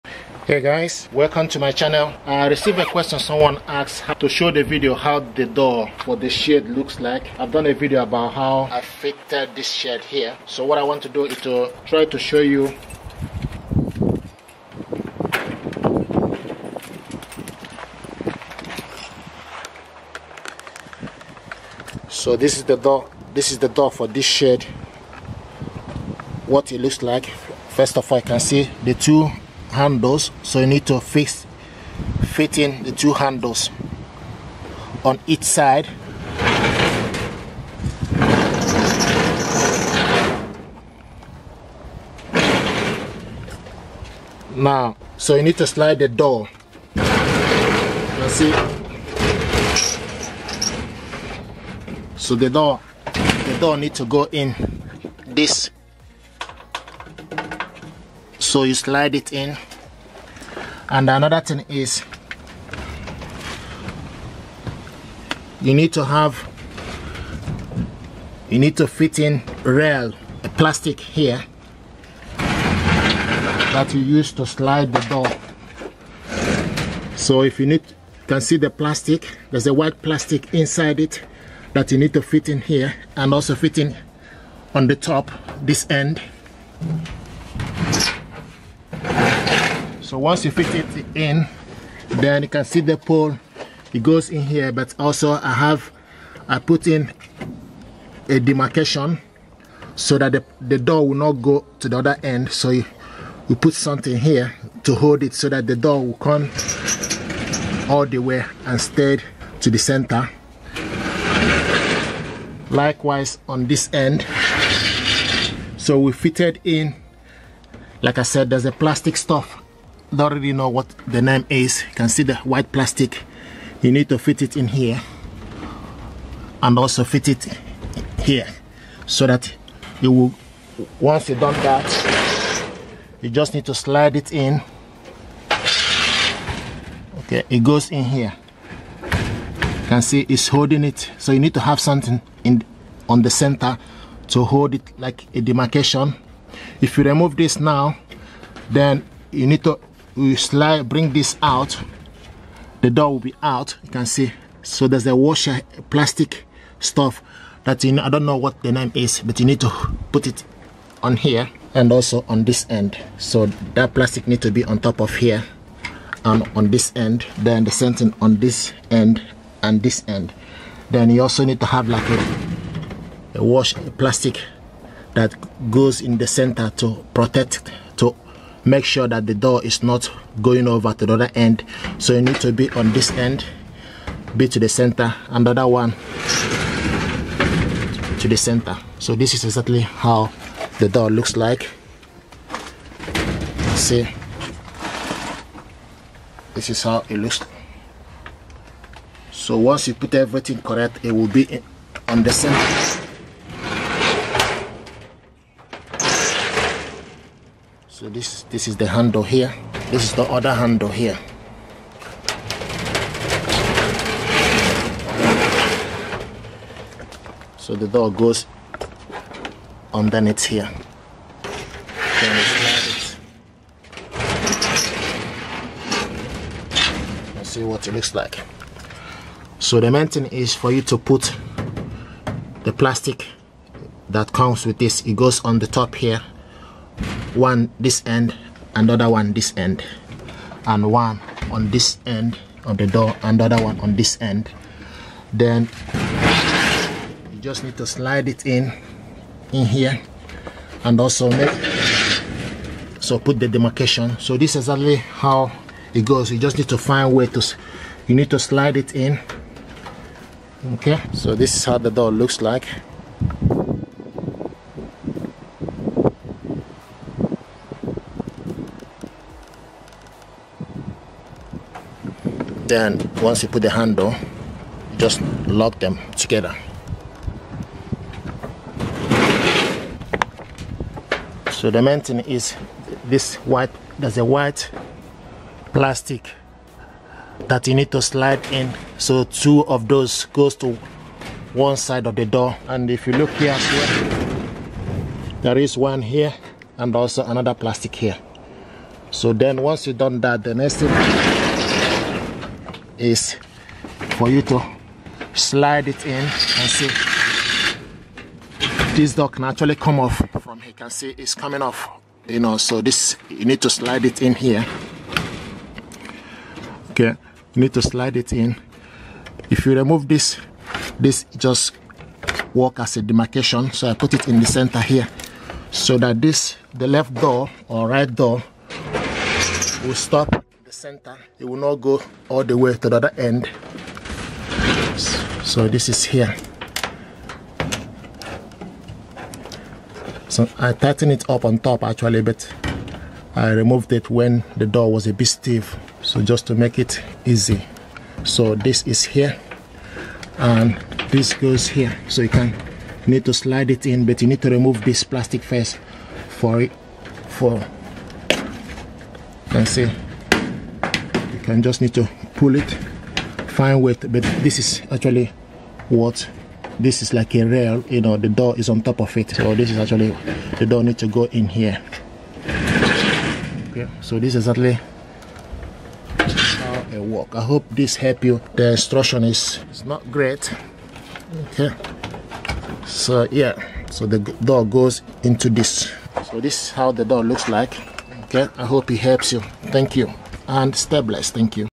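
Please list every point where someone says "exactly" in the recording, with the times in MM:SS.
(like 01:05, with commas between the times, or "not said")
03:09, 04:14.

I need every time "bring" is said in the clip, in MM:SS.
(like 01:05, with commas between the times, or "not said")
02:30.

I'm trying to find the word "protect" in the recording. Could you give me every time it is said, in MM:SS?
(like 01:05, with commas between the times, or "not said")
02:57.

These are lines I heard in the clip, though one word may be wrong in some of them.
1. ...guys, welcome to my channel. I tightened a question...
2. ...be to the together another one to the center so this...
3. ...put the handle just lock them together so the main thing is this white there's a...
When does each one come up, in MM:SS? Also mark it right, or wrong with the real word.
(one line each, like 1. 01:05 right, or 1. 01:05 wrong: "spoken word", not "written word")
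1. 00:00 wrong: "received", not "tightened"
2. 03:04 wrong: "center", not "together"
3. 04:33 right.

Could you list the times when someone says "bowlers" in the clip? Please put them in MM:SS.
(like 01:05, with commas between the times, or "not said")
not said.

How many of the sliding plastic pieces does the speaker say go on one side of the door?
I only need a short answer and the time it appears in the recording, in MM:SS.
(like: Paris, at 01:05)
2, at 04:49.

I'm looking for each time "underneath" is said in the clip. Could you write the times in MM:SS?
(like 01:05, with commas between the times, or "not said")
03:39.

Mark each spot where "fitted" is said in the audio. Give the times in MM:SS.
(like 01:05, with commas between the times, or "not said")
00:08, 01:56.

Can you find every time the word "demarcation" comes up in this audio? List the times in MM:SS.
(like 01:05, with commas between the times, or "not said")
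01:38, 02:25, 04:13, 05:23.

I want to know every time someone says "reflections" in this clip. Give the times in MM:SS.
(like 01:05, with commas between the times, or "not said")
not said.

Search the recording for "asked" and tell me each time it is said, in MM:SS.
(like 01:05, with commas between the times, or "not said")
00:03.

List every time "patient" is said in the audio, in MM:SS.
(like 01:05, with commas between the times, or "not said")
not said.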